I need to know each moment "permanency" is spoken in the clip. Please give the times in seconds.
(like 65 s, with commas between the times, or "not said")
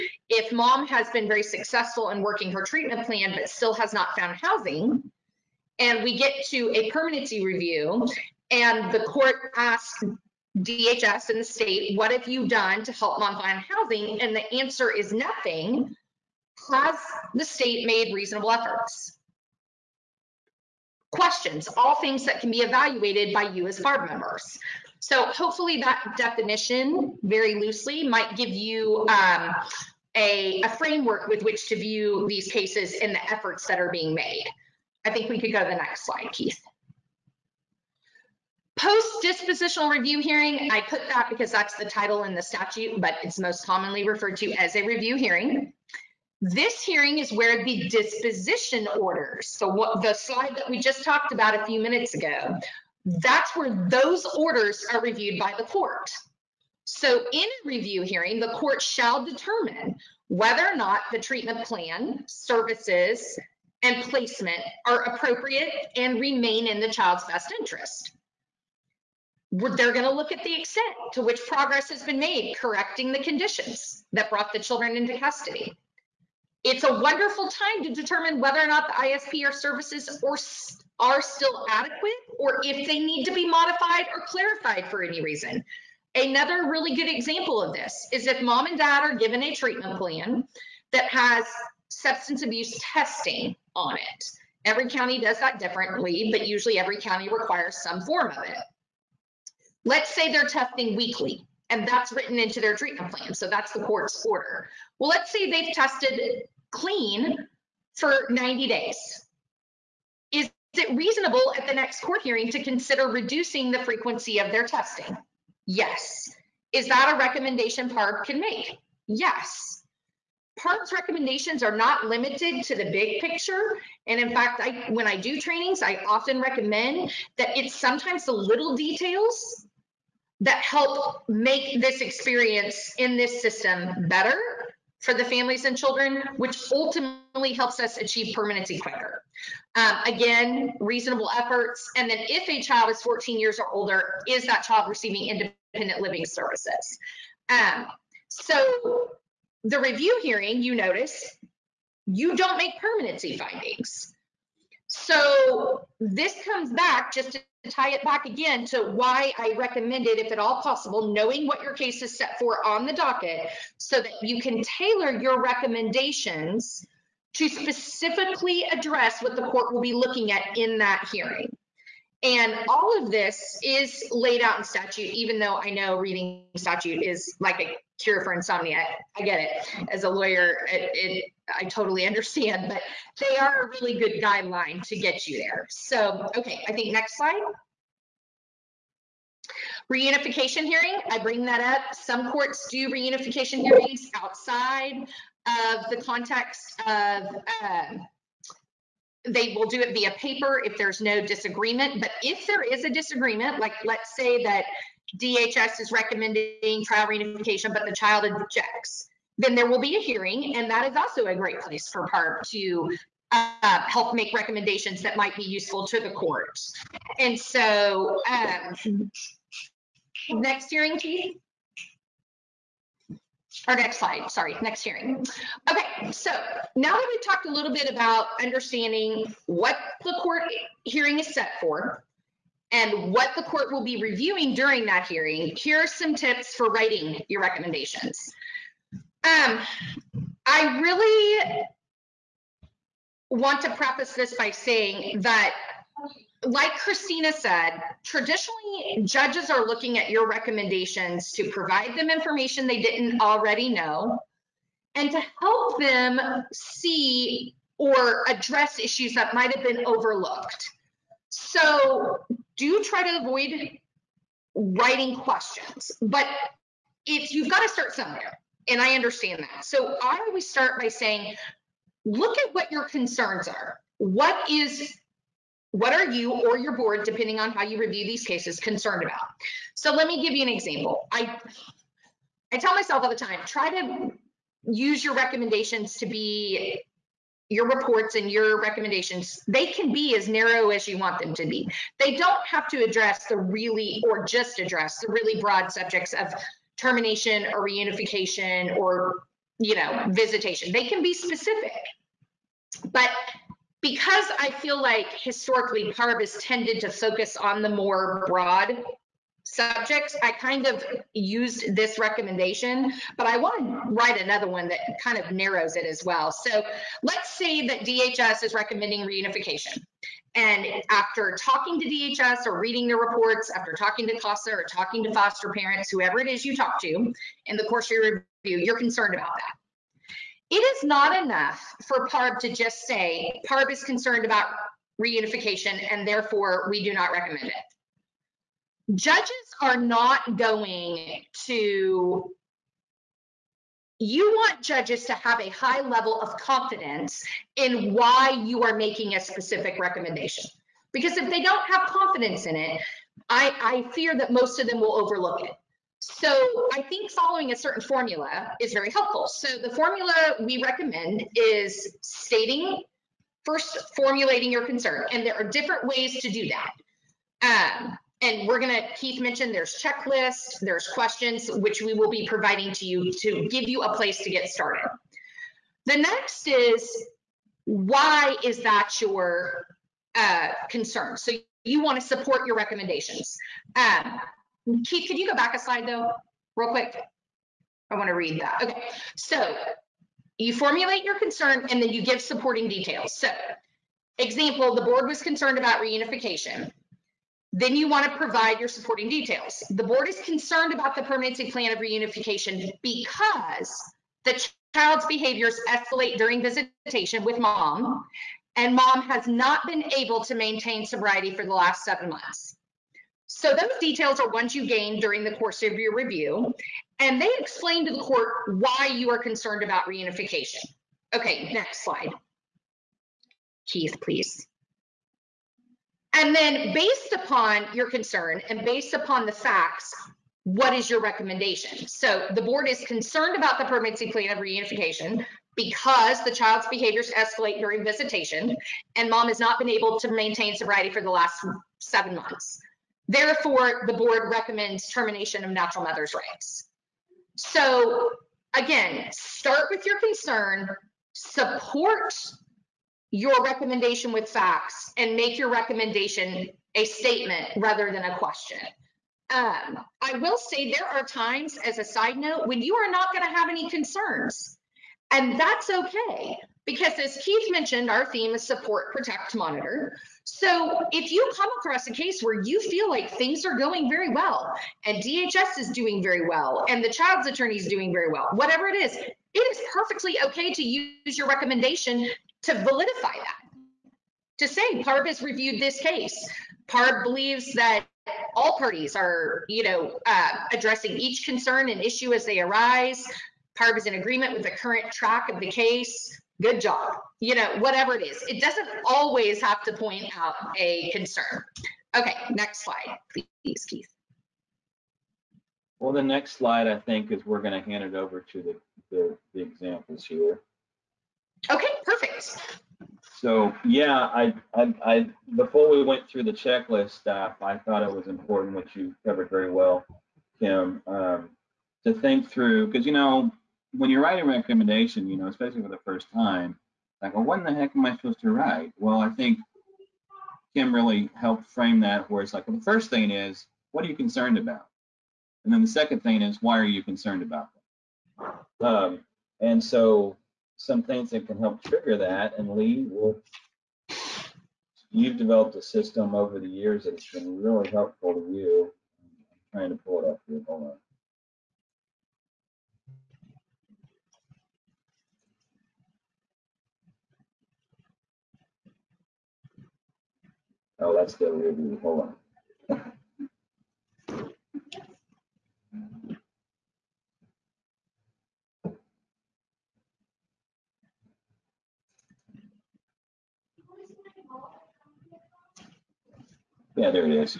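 6 s, 138 s, 152 s, 401 s, 433 s.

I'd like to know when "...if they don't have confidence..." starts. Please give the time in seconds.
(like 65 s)
351 s.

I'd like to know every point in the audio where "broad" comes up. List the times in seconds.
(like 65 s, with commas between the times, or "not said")
295 s, 308 s.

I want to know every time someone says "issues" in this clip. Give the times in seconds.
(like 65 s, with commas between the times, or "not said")
258 s, 491 s.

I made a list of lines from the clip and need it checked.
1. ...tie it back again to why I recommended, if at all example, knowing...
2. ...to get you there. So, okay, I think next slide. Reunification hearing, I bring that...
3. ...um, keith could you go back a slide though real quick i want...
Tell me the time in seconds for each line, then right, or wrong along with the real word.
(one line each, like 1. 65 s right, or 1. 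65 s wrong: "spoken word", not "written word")
1. 157 s wrong: "possible", not "example"
2. 184 s right
3. 383 s right.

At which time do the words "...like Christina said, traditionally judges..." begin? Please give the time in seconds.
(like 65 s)
246 s.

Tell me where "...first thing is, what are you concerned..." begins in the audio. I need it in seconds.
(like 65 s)
532 s.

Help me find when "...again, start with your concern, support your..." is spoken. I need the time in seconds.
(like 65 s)
448 s.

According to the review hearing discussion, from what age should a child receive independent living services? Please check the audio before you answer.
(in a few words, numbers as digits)
14.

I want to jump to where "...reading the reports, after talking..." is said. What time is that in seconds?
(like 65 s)
322 s.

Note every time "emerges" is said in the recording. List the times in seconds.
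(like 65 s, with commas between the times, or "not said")
not said.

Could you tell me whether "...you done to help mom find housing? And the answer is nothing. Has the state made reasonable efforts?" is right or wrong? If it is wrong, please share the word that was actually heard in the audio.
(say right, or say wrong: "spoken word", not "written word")
right.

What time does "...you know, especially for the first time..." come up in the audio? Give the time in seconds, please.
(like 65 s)
525 s.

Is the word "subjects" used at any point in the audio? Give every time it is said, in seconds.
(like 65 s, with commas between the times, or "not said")
295 s, 309 s.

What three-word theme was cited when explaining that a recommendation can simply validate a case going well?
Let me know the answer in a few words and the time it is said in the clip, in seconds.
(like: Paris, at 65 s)
support, protect, monitor, at 468 s.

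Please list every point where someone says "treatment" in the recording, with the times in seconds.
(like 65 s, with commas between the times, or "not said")
2 s, 61 s, 89 s, 102 s.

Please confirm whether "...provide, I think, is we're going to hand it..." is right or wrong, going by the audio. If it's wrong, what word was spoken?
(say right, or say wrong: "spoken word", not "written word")
wrong: "slide", not "provide".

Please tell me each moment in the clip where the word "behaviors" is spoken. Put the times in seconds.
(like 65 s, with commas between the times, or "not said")
405 s, 436 s.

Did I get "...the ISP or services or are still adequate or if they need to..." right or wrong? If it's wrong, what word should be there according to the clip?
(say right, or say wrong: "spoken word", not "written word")
right.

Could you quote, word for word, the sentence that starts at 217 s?
And so, um, next hearing, Keith?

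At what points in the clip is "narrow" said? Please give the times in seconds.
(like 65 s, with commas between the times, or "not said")
290 s, 315 s.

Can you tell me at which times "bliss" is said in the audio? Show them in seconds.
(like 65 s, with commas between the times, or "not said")
not said.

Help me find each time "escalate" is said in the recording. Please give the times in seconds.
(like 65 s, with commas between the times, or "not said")
405 s, 437 s.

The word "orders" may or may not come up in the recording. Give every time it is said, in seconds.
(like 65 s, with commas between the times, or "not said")
48 s, 54 s, 104 s.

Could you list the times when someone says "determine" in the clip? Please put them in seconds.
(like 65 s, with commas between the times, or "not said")
59 s, 77 s.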